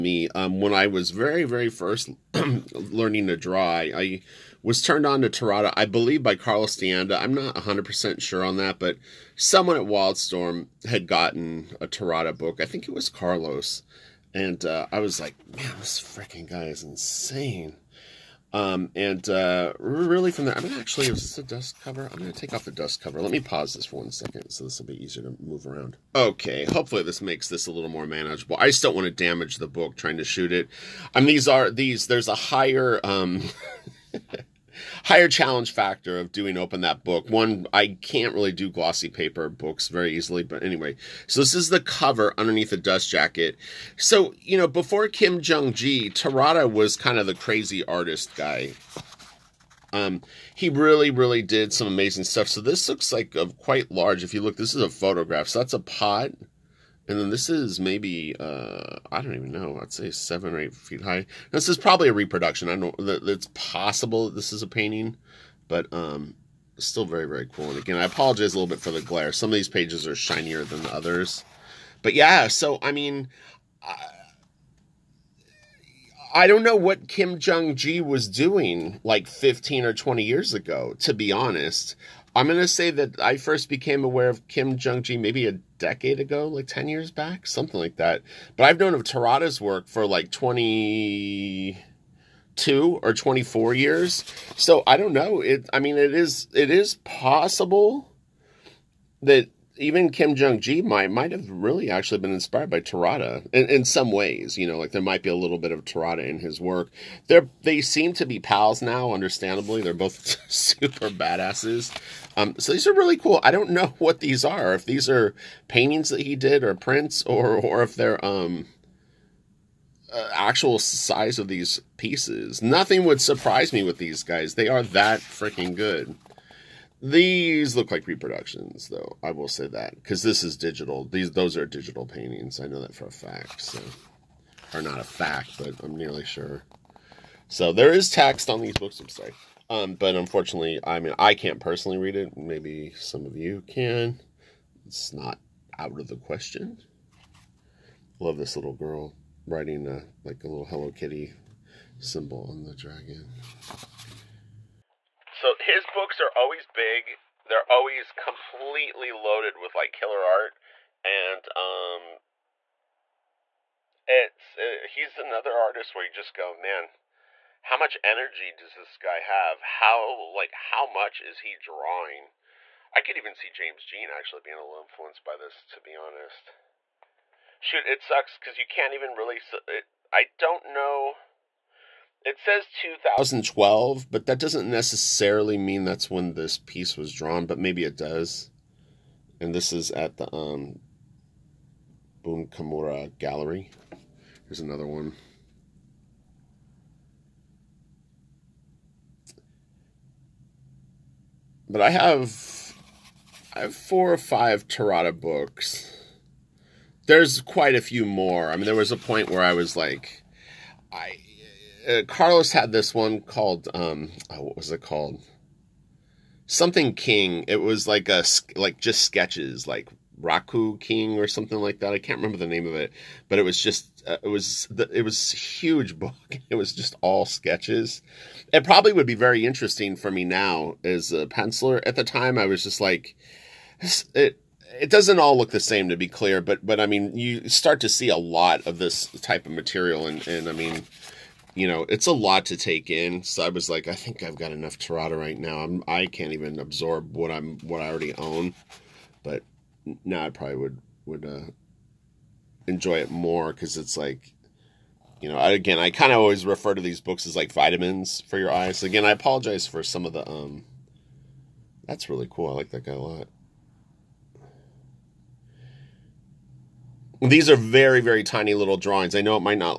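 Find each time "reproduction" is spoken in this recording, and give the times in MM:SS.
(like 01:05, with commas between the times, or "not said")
01:02, 02:08.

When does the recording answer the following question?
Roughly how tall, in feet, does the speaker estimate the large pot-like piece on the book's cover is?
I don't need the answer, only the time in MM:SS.
01:00.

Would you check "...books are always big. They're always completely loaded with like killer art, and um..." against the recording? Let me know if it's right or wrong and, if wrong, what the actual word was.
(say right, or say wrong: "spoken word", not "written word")
right.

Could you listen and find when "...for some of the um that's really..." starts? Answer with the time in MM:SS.
04:19.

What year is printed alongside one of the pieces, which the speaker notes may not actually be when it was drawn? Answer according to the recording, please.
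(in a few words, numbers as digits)
2012.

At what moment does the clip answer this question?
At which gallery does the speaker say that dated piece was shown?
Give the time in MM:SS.
03:12.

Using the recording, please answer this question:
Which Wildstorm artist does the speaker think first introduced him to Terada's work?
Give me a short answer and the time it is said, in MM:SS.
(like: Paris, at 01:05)
Carlos D'Anda, at 00:06.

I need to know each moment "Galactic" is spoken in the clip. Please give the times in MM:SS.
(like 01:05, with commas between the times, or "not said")
not said.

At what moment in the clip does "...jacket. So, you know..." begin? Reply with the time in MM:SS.
00:43.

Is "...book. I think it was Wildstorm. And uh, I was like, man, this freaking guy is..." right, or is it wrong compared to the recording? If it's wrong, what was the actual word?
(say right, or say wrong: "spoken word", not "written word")
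wrong: "Carlos", not "Wildstorm".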